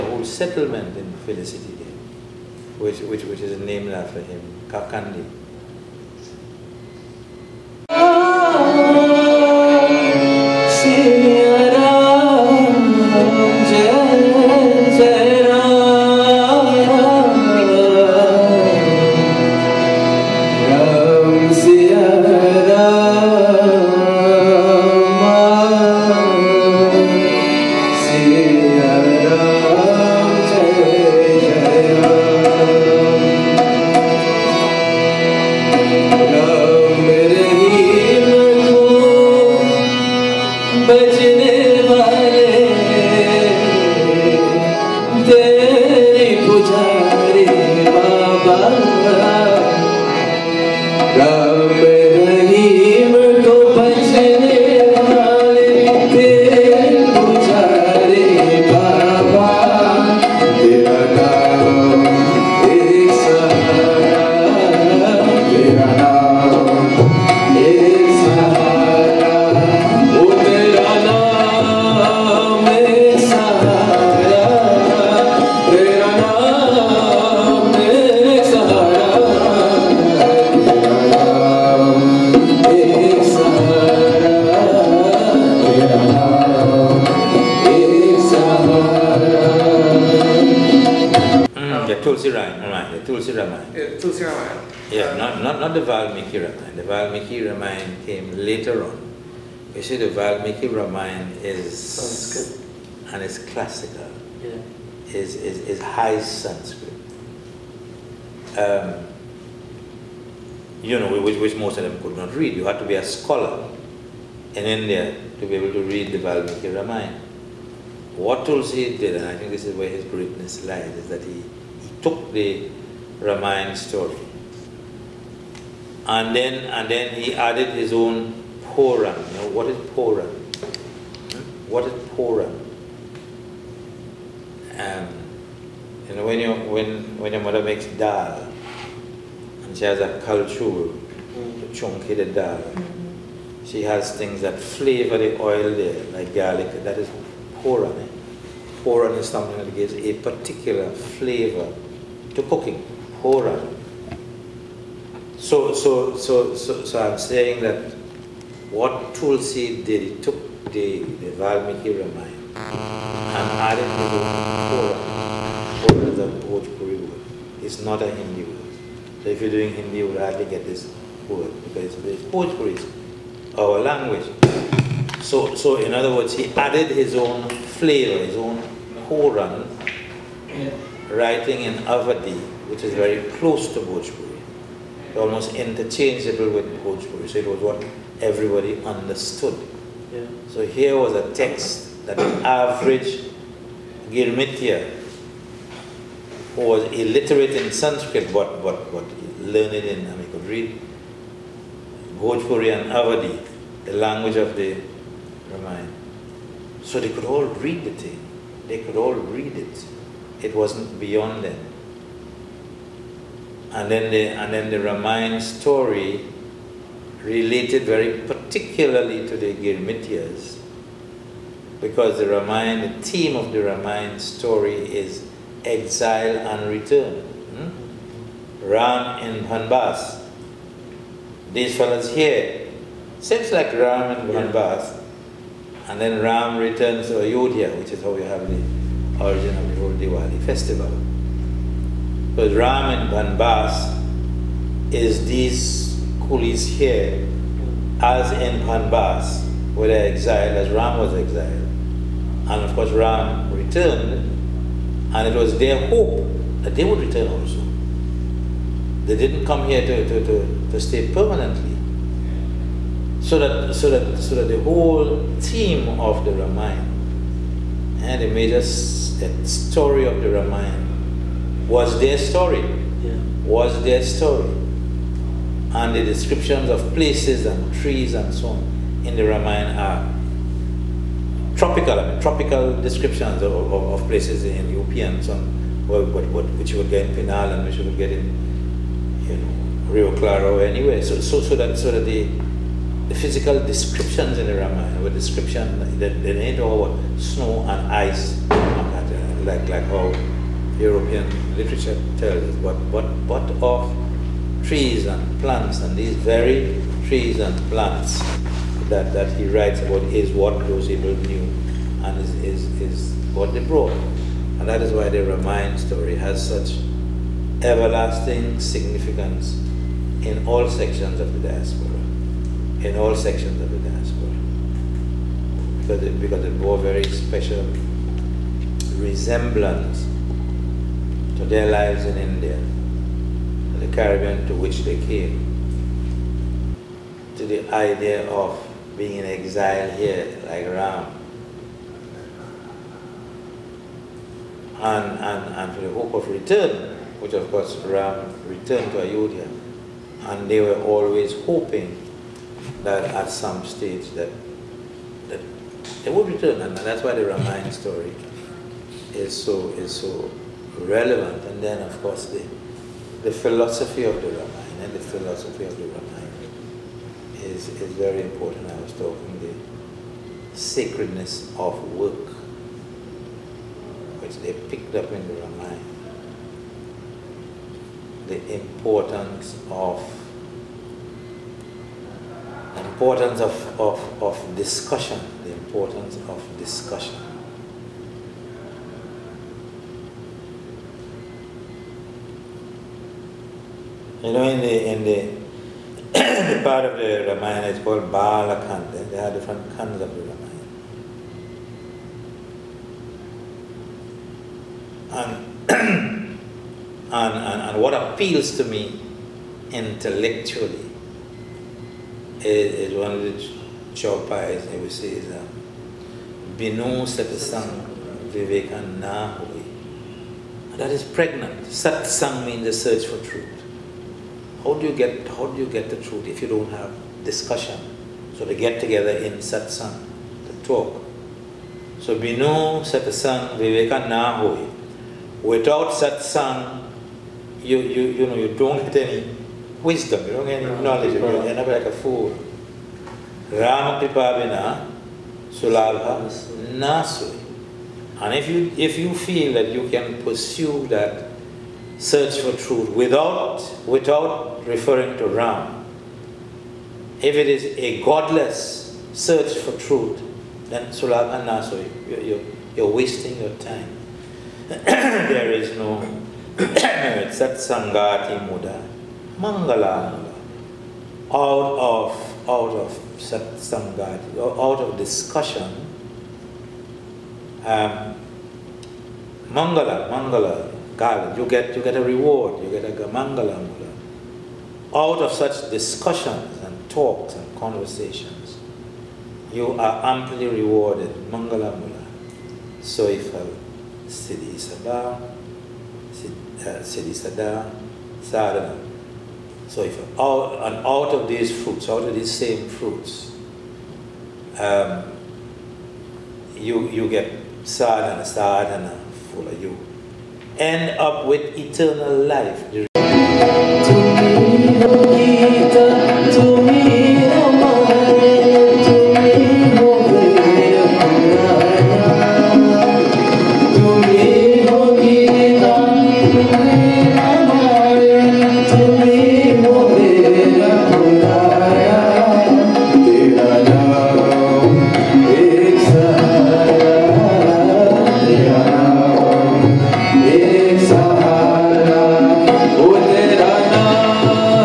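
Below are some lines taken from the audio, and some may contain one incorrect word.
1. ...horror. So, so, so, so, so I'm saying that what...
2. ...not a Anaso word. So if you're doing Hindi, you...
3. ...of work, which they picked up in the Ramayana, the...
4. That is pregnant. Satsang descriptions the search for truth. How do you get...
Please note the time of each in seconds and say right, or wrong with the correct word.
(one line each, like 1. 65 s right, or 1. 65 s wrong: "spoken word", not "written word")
1. 153 s right
2. 167 s wrong: "Hindi", not "Anaso"
3. 371 s right
4. 420 s wrong: "means", not "descriptions".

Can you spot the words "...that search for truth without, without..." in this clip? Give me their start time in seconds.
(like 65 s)
450 s.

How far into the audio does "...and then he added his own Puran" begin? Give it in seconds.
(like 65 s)
126 s.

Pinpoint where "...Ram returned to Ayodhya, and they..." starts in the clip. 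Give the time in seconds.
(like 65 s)
347 s.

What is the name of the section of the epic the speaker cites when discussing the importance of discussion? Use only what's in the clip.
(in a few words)
Balakanda.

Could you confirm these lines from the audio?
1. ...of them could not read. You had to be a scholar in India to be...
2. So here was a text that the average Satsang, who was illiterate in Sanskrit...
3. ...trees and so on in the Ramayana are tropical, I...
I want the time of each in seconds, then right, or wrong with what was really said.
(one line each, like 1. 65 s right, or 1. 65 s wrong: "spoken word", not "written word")
1. 111 s right
2. 190 s wrong: "Girmitya", not "Satsang"
3. 277 s right.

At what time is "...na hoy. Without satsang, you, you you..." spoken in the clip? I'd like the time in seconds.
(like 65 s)
434 s.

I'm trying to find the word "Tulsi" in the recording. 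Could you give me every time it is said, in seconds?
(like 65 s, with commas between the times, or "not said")
118 s, 159 s.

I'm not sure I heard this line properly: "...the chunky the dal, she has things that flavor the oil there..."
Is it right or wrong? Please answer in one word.
right.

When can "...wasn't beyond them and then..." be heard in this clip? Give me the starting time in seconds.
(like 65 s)
210 s.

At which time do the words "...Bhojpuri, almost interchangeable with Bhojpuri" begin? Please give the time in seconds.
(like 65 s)
183 s.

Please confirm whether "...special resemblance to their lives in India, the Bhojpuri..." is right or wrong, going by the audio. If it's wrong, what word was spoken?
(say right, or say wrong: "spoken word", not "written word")
wrong: "Caribbean", not "Bhojpuri".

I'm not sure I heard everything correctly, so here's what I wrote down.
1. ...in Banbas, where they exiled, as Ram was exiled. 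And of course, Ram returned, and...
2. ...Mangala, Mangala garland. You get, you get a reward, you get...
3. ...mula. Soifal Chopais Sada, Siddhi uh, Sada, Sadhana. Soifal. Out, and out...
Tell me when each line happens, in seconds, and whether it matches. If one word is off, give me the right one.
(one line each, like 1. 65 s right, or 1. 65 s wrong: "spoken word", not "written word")
1. 248 s right
2. 479 s right
3. 491 s wrong: "Siddhi", not "Chopais".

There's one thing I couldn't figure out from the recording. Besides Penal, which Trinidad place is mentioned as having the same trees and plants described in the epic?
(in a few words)
Rio Claro.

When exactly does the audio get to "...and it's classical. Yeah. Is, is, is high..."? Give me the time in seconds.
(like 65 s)
103 s.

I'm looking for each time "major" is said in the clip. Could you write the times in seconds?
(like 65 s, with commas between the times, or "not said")
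268 s.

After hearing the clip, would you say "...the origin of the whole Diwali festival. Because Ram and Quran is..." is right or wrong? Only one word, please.
wrong.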